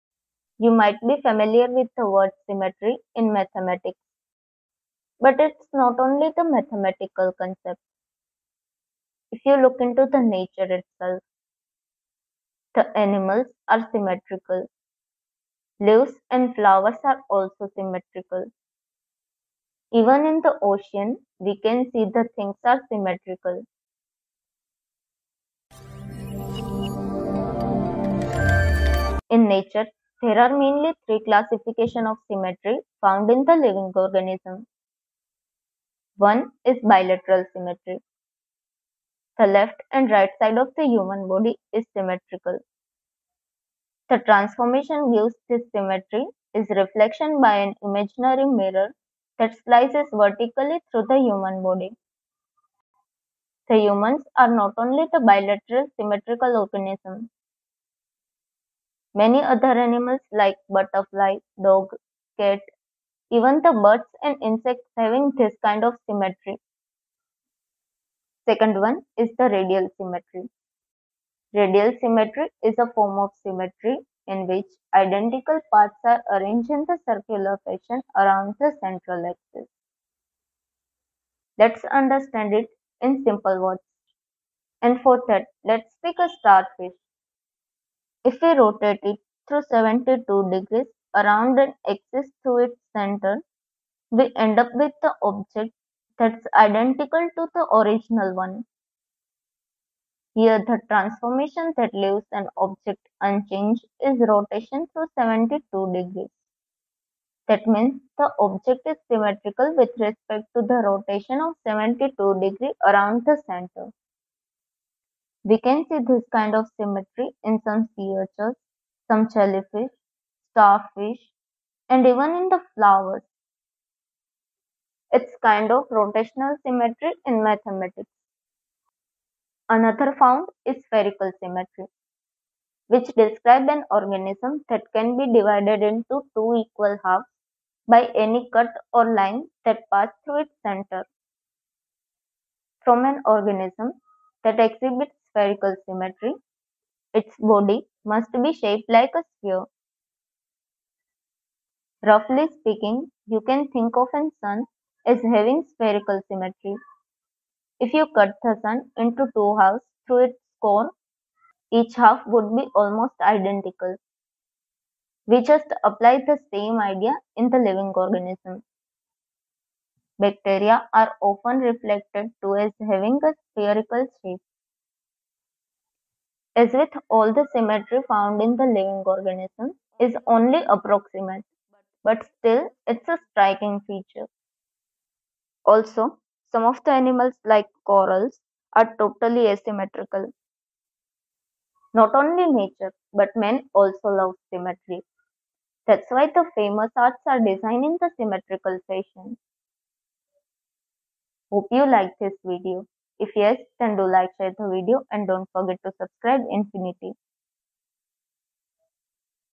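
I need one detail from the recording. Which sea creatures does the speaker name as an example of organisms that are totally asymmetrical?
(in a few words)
corals.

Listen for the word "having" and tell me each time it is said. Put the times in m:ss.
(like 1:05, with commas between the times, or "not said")
1:04, 2:35, 2:52.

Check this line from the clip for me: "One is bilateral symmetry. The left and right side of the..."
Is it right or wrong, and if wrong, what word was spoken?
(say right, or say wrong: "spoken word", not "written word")
right.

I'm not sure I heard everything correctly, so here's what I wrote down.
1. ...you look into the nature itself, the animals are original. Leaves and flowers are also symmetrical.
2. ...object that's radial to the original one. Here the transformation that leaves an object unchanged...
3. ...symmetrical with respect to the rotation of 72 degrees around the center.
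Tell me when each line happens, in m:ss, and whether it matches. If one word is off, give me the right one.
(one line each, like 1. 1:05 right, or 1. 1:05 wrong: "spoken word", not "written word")
1. 0:09 wrong: "symmetrical", not "original"
2. 1:35 wrong: "identical", not "radial"
3. 1:49 right.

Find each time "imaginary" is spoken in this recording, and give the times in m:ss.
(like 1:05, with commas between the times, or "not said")
0:47.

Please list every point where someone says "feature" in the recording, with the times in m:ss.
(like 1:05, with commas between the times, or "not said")
3:03.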